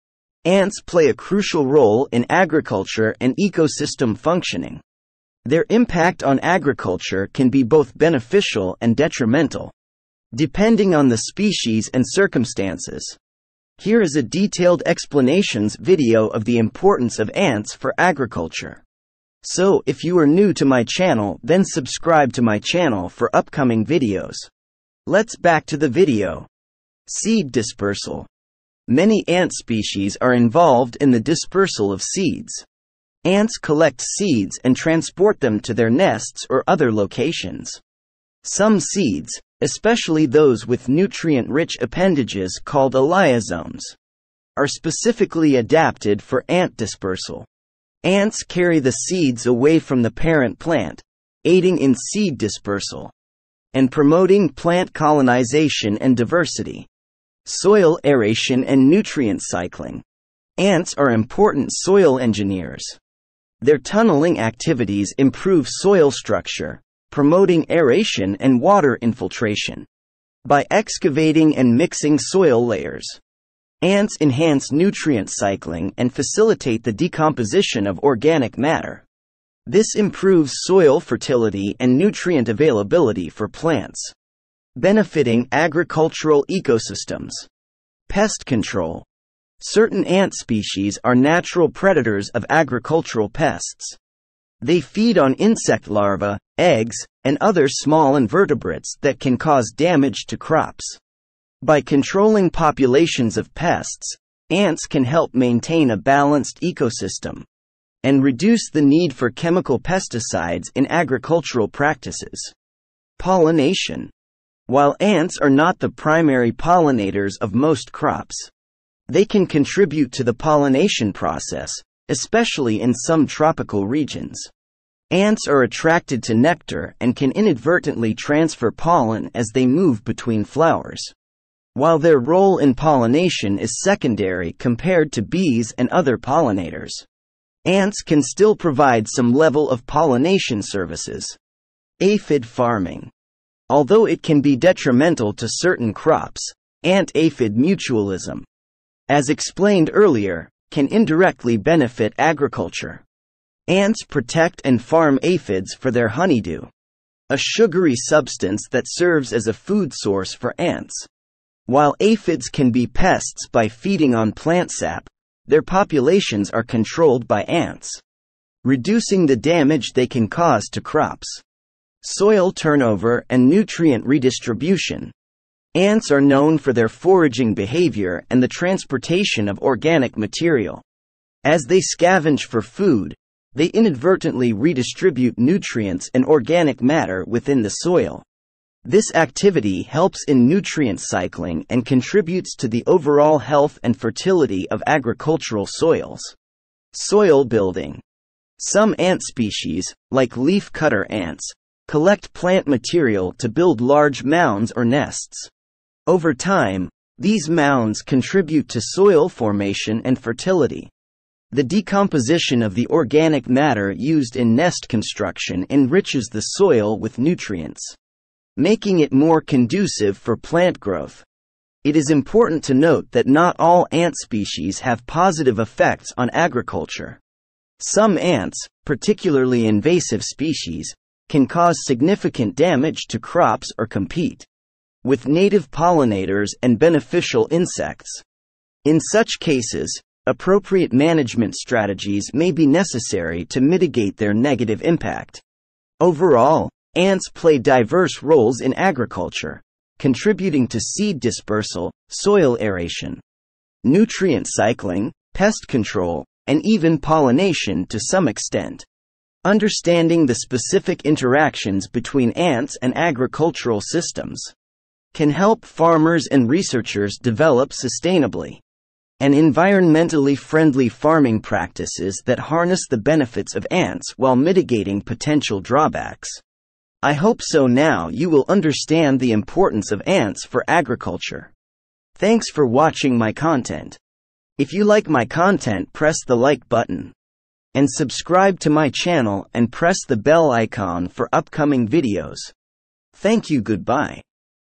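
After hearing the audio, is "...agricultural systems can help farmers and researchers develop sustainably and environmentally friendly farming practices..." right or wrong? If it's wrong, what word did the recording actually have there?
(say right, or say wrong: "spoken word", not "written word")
right.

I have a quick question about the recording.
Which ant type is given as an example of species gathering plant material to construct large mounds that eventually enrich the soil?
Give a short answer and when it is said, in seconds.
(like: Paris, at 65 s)
leafcutter ants, at 200 s.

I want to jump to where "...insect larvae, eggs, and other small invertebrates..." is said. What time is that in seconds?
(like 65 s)
95 s.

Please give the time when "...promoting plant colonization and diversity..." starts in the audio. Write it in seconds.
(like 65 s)
53 s.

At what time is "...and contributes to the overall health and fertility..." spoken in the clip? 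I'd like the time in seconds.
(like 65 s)
191 s.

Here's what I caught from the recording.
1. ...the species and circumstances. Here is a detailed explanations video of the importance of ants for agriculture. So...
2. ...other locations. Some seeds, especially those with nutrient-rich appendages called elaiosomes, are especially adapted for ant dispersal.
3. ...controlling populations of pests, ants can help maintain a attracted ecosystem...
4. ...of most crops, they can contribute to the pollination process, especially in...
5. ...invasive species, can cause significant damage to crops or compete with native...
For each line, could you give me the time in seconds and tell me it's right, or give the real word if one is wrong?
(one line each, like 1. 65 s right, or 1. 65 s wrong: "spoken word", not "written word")
1. 11 s right
2. 36 s wrong: "specifically", not "especially"
3. 101 s wrong: "balanced", not "attracted"
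4. 117 s right
5. 229 s right.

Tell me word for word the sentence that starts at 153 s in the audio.
Ants protect and farm aphids for their honeydew, a sugary substance that serves as a food source for ants.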